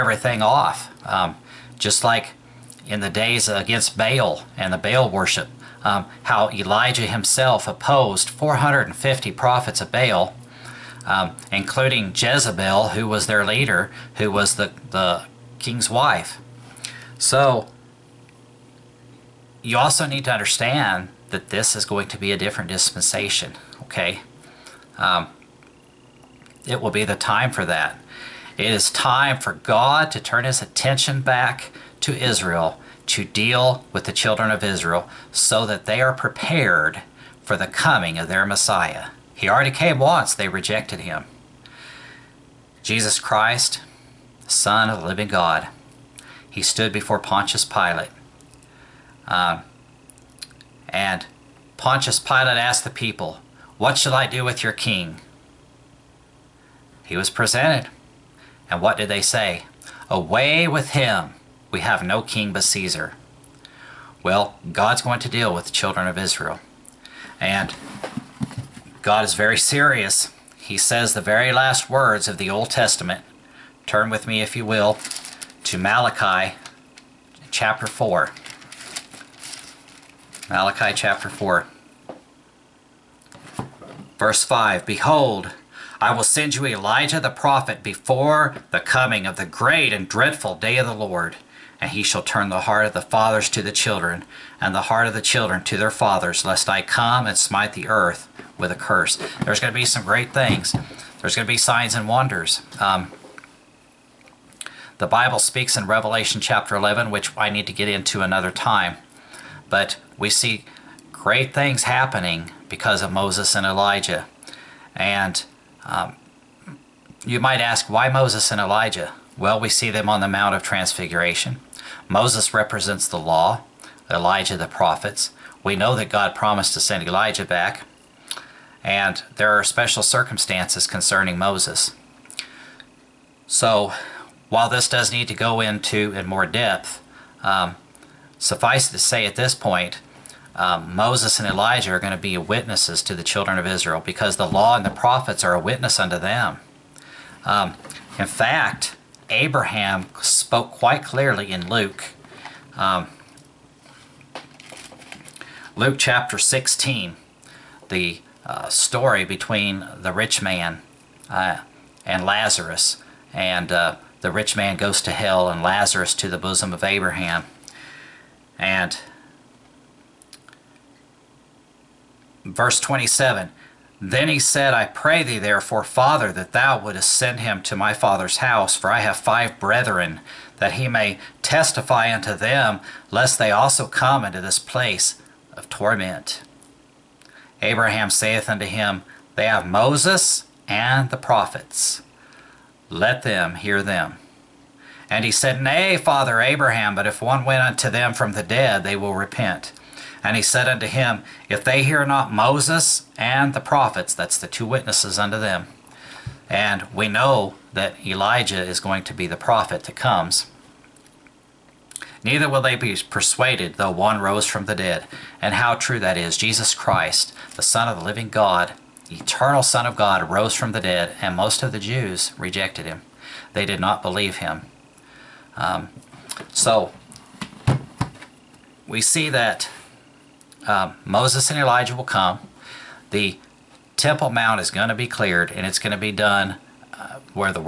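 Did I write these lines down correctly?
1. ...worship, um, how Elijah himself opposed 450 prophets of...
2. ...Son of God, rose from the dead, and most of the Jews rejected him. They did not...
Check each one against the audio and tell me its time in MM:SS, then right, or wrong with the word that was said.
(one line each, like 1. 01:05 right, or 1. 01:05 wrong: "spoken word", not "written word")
1. 00:05 right
2. 03:39 right.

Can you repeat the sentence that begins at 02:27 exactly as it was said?
Um, in fact, Abraham spoke quite clearly in Luke.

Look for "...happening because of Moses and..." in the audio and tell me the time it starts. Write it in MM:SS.
01:51.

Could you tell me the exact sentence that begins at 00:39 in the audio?
He already came once, they rejected him.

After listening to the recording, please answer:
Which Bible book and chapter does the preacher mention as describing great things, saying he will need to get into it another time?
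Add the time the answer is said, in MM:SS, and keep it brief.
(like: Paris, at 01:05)
Revelation 11, at 01:45.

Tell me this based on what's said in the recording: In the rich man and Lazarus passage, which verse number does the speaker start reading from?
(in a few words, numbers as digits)
27.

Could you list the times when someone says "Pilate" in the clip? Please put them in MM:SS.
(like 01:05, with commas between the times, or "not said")
00:47, 00:52.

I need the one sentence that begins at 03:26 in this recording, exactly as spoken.
And we know that Elijah is going to be the prophet that comes.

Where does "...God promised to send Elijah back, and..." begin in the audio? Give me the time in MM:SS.
02:06.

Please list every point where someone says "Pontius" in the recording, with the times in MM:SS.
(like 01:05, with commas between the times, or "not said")
00:47, 00:51.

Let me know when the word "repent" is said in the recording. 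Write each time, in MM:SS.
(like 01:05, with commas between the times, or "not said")
03:19.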